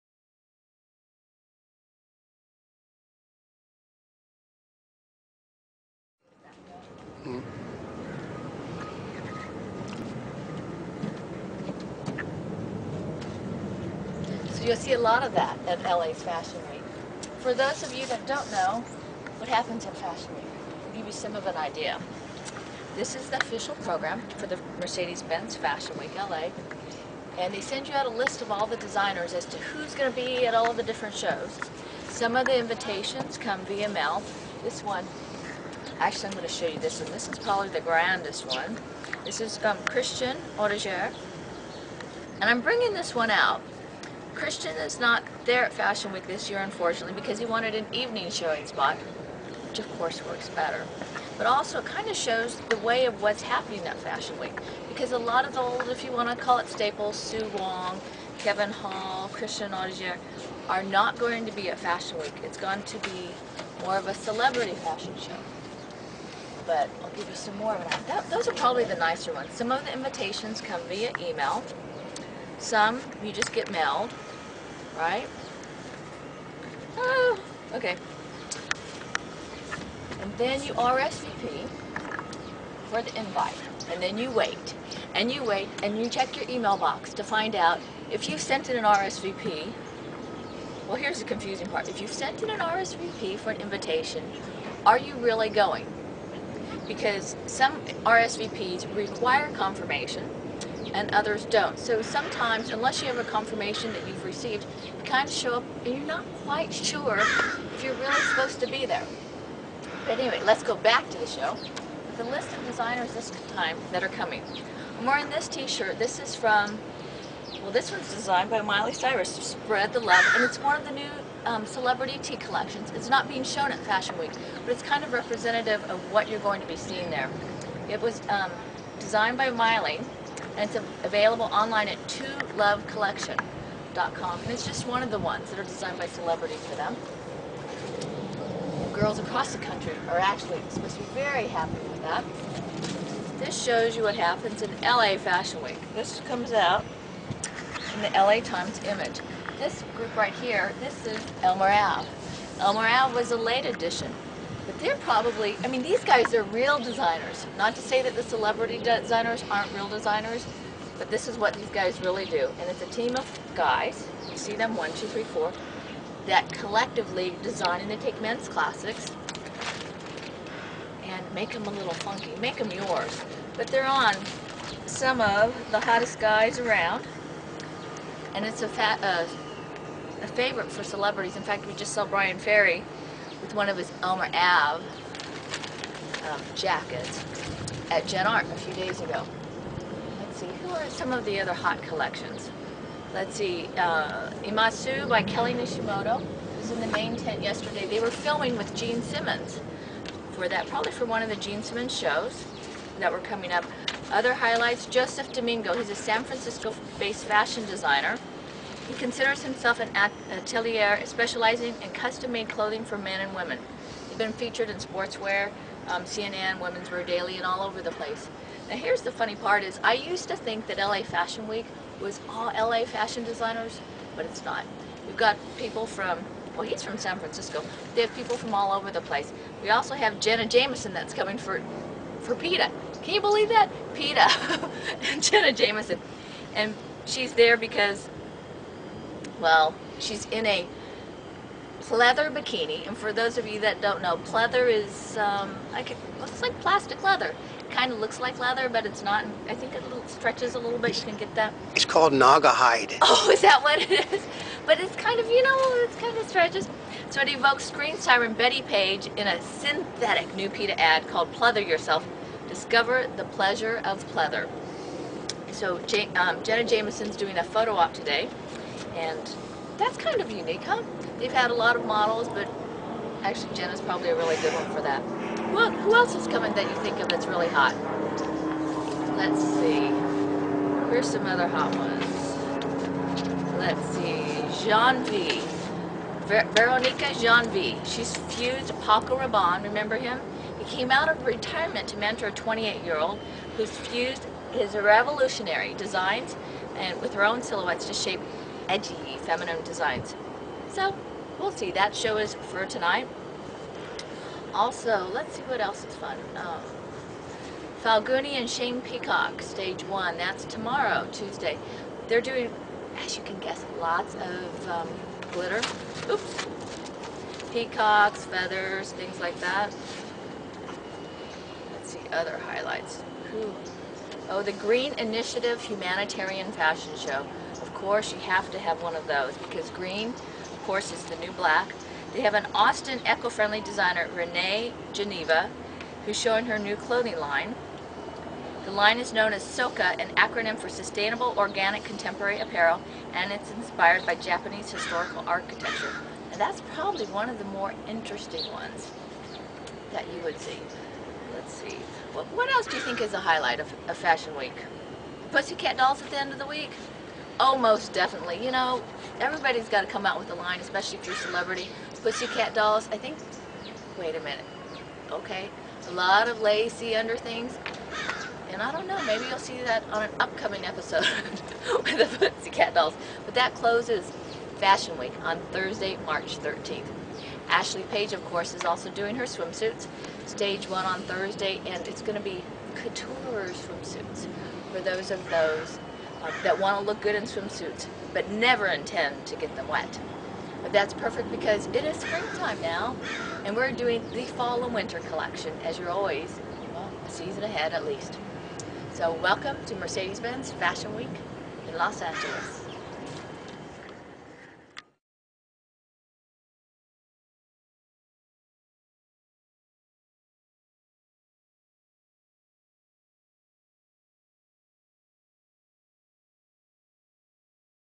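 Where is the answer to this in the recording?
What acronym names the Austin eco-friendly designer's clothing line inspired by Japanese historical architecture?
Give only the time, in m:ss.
5:39.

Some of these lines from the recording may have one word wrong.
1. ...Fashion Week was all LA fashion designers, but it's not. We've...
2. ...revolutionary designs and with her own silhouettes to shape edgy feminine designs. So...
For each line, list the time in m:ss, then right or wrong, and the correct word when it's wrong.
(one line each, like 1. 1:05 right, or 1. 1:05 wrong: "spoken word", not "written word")
1. 3:41 right
2. 4:54 right.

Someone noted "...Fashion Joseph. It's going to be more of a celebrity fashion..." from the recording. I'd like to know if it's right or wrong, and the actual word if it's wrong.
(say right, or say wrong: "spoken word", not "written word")
wrong: "Week", not "Joseph".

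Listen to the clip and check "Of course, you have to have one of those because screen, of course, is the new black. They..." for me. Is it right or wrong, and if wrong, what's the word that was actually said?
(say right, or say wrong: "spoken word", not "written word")
wrong: "green", not "screen".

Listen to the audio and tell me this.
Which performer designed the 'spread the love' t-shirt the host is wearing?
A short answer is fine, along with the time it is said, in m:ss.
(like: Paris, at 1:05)
Miley Cyrus, at 1:58.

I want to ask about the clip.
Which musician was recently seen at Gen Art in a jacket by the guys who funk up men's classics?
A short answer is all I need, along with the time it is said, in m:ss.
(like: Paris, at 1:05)
Bryan Ferry, at 3:02.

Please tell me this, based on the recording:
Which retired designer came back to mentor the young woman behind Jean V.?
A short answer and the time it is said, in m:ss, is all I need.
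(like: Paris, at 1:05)
Paco Rabanne, at 4:48.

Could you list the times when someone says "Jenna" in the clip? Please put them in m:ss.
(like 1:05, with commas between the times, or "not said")
3:50, 3:55, 4:26.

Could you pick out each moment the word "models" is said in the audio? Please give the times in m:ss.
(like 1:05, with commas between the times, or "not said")
4:31.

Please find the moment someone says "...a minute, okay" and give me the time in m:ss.
6:04.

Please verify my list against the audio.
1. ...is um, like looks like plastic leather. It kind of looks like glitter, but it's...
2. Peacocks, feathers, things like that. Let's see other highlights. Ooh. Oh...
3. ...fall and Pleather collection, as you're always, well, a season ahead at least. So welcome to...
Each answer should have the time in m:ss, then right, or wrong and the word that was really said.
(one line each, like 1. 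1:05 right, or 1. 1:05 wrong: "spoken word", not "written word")
1. 4:04 wrong: "leather", not "glitter"
2. 5:17 right
3. 6:34 wrong: "winter", not "Pleather".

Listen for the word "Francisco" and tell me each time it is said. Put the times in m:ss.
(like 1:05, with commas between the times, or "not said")
3:26, 3:47.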